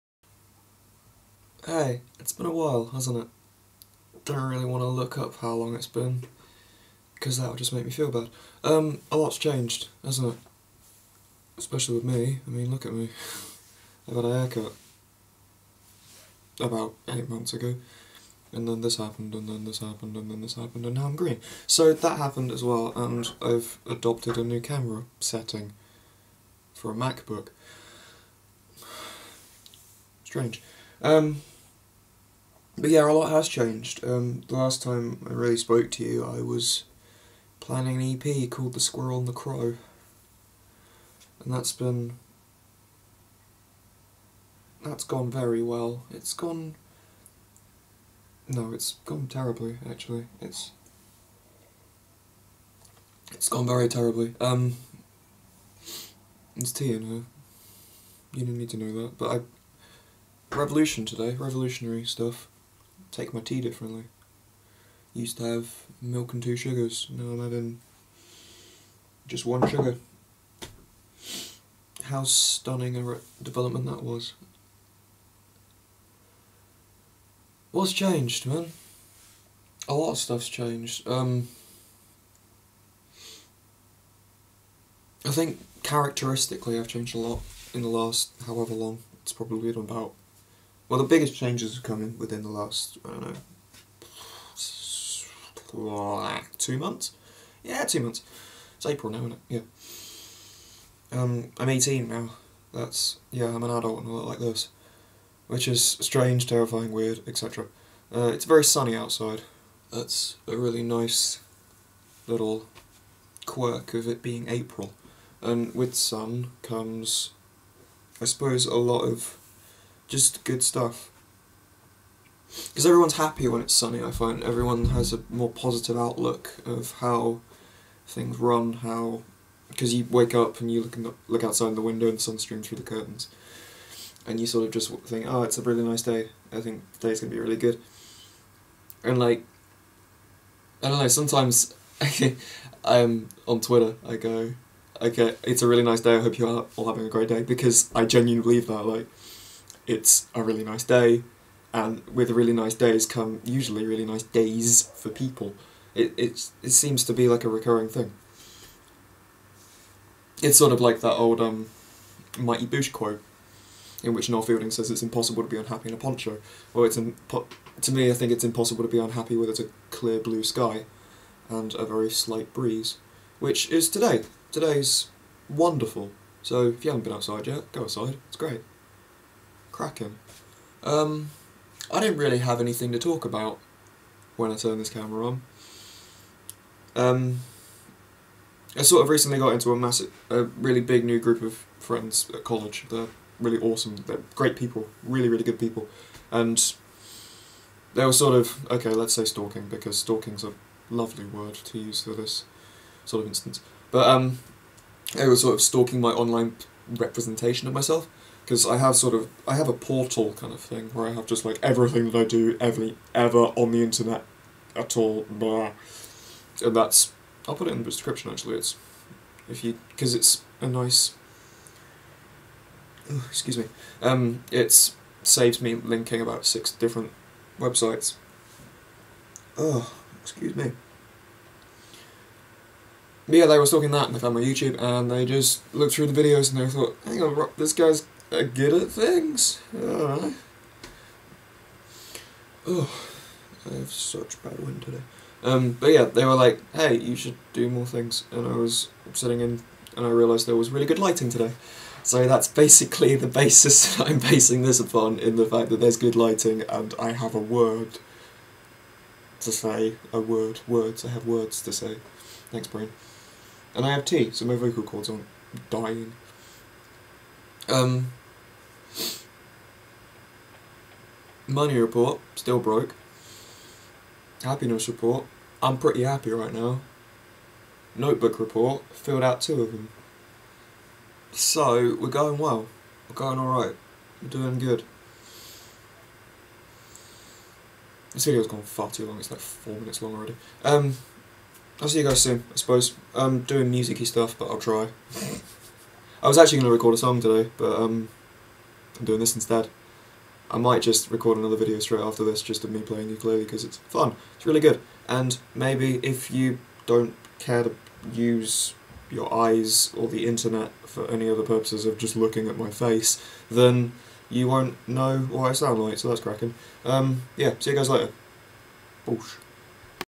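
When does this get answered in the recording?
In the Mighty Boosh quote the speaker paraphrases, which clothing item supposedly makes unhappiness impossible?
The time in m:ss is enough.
2:45.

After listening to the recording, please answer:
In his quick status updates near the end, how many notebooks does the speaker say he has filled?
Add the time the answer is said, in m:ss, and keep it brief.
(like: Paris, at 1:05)
2, at 4:39.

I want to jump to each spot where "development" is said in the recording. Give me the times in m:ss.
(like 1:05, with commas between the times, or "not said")
1:13.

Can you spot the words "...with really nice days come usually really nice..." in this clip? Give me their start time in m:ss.
2:32.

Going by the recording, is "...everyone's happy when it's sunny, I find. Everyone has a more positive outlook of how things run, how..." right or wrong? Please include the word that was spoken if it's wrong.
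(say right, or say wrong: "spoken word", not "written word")
right.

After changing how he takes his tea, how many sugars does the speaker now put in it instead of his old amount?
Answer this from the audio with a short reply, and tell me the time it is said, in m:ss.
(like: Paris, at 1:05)
1, at 1:09.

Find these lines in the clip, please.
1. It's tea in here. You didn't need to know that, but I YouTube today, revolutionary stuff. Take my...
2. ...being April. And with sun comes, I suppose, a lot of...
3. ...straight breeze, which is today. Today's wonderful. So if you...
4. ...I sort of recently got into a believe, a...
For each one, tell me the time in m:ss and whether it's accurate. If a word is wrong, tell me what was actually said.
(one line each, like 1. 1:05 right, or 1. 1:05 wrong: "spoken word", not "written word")
1. 0:56 wrong: "Revolution", not "YouTube"
2. 1:54 right
3. 2:52 wrong: "slight", not "straight"
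4. 3:08 wrong: "massive", not "believe".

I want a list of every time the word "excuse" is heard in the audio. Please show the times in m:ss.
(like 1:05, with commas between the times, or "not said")
3:43, 3:50.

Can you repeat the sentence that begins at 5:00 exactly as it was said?
I might just record another video straight after this just of me playing ukulele because it's fun, it's really good.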